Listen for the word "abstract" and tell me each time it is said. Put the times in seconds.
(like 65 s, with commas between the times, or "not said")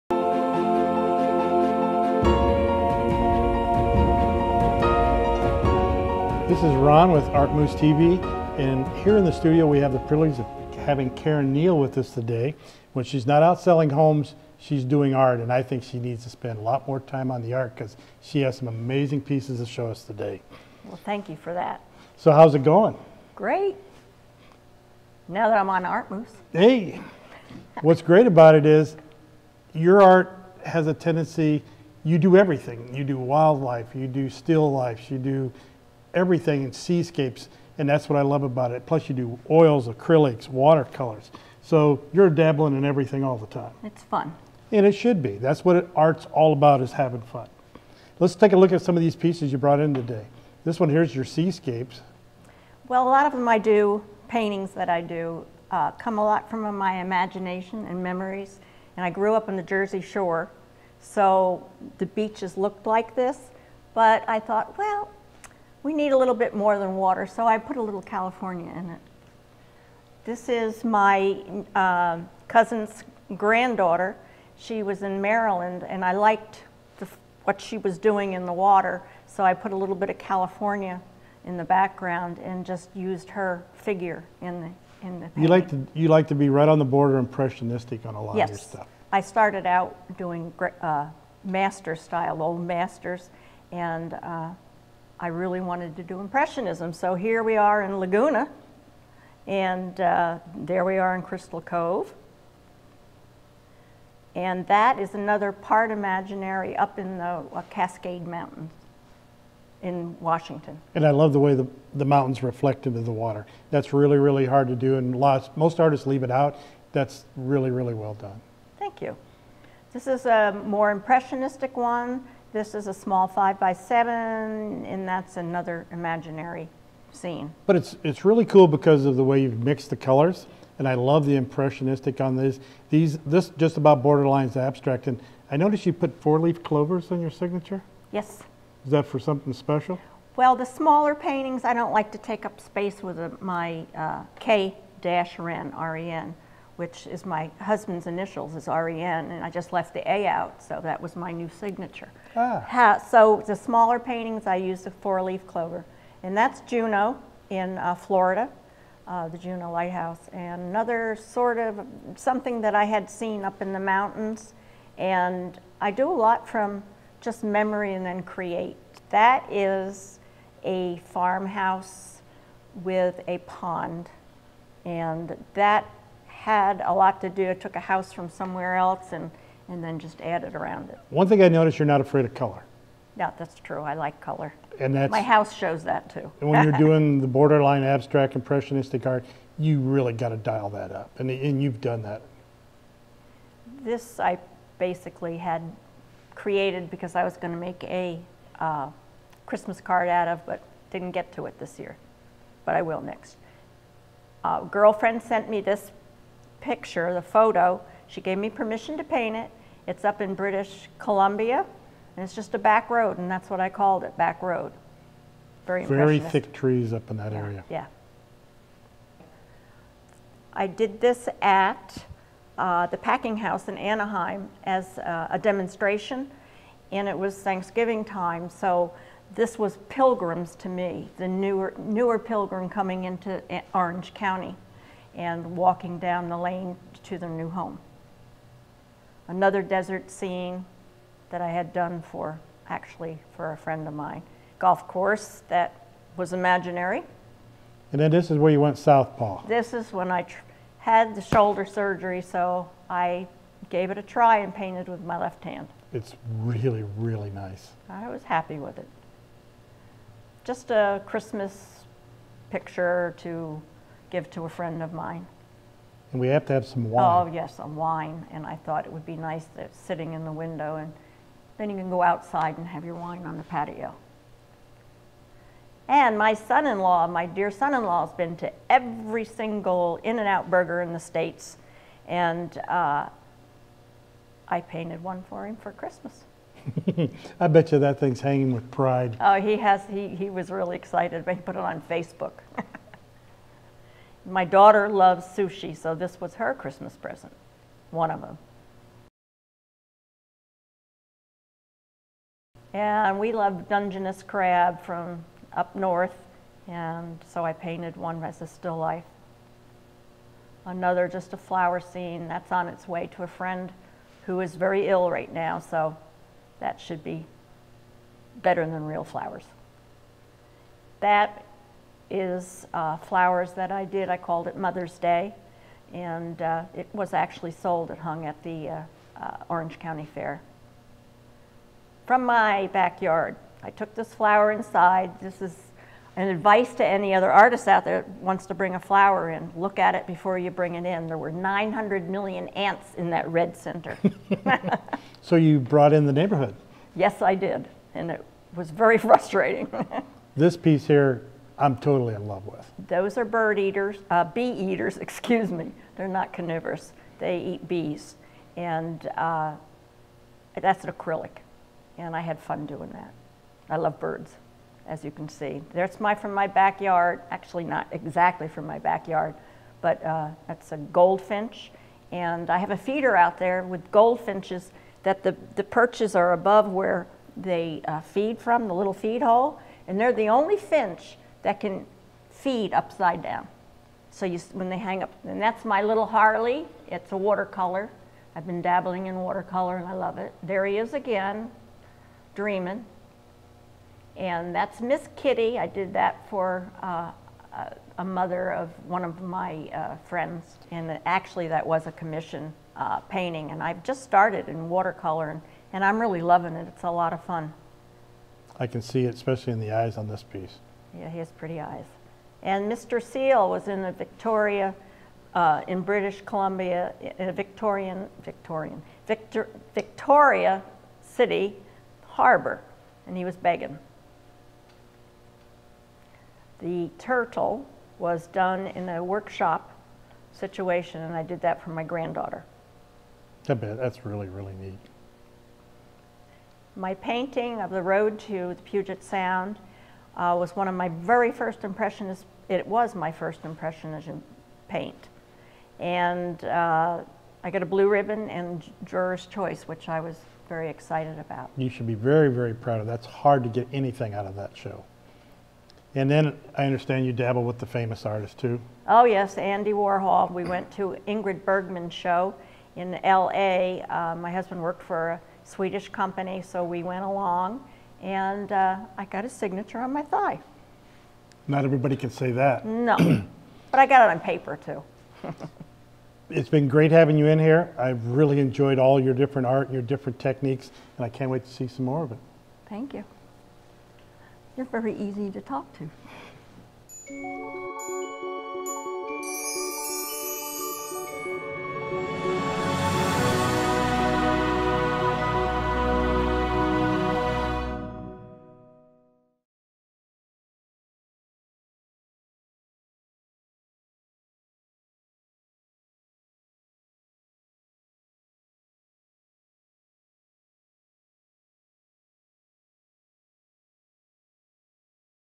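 134 s, 187 s.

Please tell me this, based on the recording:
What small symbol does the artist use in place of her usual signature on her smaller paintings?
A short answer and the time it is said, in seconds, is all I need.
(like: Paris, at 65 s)
four-leaf clover, at 154 s.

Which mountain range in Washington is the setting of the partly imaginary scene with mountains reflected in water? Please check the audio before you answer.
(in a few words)
Cascade Mountains.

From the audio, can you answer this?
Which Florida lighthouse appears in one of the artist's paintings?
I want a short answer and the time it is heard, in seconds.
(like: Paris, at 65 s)
Juno Lighthouse, at 159 s.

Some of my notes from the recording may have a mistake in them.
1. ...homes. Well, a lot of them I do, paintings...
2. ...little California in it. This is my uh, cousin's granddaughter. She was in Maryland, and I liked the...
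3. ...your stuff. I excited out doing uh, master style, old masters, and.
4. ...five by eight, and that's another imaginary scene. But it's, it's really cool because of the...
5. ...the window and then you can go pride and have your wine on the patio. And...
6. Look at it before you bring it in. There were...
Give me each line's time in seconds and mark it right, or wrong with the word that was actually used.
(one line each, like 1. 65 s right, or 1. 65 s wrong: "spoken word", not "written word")
1. 51 s wrong: "seascapes", not "homes"
2. 67 s right
3. 88 s wrong: "started", not "excited"
4. 123 s wrong: "seven", not "eight"
5. 270 s wrong: "outside", not "pride"
6. 339 s right.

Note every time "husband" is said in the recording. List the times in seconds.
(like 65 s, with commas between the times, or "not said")
147 s, 464 s.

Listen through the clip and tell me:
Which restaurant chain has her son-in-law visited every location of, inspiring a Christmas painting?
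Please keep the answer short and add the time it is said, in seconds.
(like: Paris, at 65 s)
In-N-Out, at 280 s.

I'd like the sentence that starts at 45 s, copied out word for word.
That's what art's all about is having fun.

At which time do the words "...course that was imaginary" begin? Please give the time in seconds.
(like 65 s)
244 s.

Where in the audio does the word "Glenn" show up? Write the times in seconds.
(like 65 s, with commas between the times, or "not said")
not said.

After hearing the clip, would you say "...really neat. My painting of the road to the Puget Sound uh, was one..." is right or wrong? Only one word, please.
right.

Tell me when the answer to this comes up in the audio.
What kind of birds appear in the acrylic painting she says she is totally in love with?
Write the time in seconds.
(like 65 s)
354 s.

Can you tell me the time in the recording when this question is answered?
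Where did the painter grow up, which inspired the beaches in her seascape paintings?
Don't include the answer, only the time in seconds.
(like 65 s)
59 s.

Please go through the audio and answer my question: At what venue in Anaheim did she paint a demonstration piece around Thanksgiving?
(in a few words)
the packing house.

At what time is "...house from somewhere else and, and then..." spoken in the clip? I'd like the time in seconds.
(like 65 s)
177 s.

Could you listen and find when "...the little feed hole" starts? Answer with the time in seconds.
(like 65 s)
378 s.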